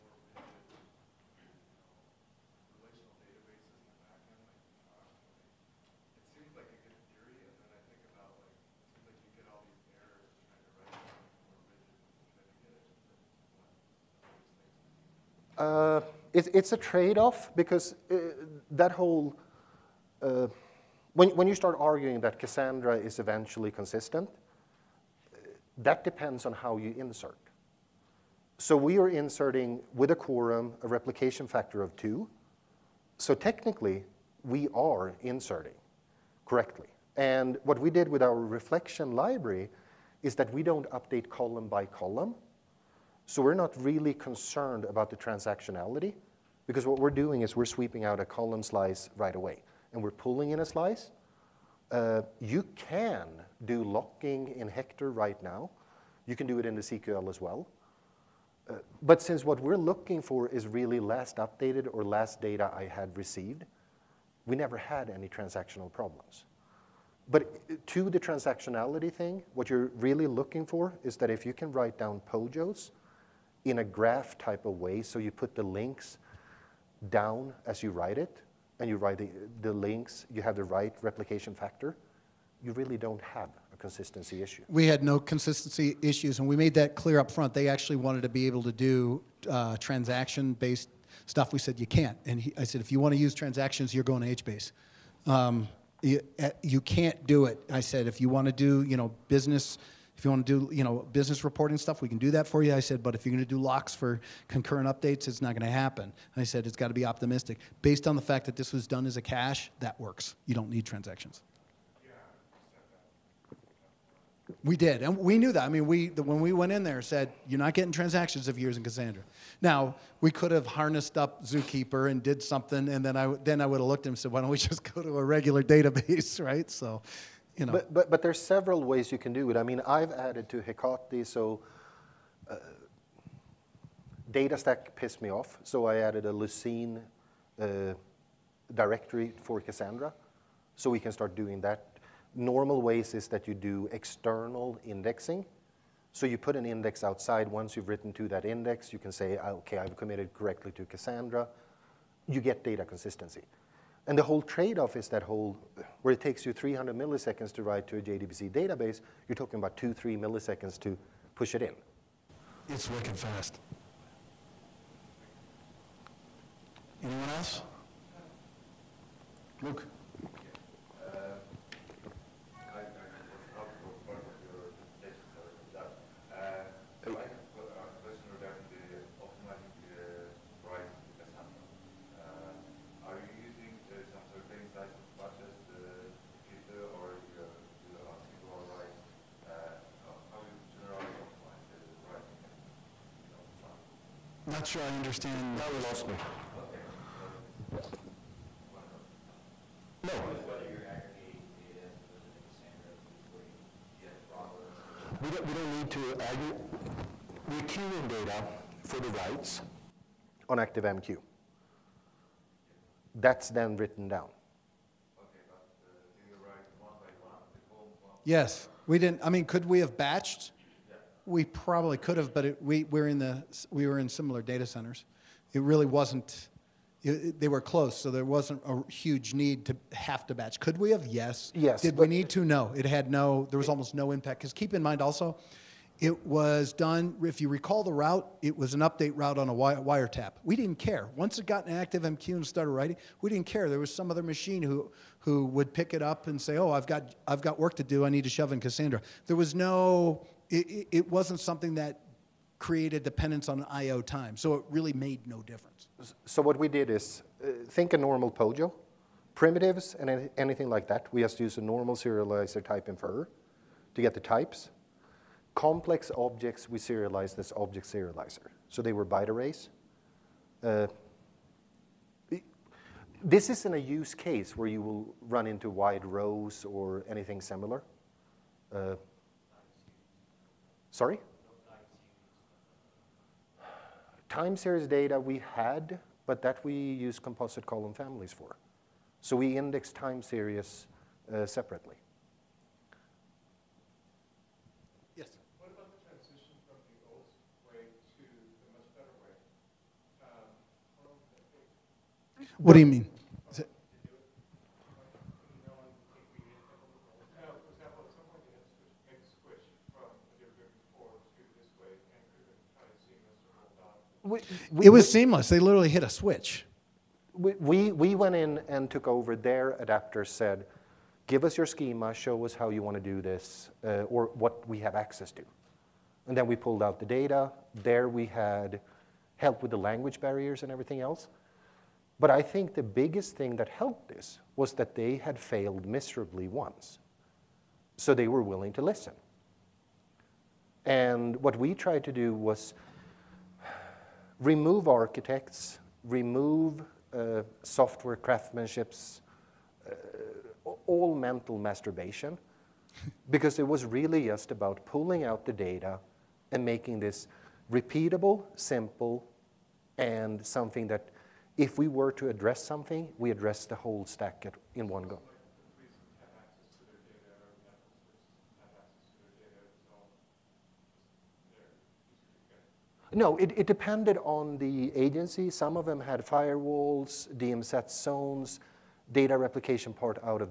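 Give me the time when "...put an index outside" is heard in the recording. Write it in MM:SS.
02:26.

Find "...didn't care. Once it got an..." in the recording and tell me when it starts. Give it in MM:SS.
04:00.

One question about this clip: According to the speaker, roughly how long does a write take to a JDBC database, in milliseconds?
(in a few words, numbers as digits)
300.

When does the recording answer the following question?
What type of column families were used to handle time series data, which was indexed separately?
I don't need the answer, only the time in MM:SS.
04:47.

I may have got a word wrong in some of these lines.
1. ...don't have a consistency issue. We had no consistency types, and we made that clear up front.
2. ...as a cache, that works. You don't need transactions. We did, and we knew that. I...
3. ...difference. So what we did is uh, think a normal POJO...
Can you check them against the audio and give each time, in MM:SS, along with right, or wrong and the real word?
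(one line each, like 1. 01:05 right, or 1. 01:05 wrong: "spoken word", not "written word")
1. 01:22 wrong: "issues", not "types"
2. 01:49 right
3. 04:15 right.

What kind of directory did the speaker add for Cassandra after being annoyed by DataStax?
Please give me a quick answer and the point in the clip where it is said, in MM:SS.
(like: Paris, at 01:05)
Lucene, at 02:16.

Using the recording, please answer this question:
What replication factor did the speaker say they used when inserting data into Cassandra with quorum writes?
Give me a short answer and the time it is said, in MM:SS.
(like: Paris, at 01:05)
2, at 00:30.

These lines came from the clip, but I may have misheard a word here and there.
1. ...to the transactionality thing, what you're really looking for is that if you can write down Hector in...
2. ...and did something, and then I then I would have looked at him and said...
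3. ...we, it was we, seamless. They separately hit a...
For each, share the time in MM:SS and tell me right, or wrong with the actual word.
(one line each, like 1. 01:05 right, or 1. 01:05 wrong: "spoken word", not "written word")
1. 01:07 wrong: "POJOs", not "Hector"
2. 02:02 right
3. 05:14 wrong: "literally", not "separately".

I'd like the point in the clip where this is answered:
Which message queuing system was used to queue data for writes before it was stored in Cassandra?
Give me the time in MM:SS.
03:30.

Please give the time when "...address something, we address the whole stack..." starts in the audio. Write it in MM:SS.
06:02.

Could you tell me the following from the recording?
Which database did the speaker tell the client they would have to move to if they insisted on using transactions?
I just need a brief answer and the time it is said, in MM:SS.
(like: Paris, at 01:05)
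HBase, at 01:34.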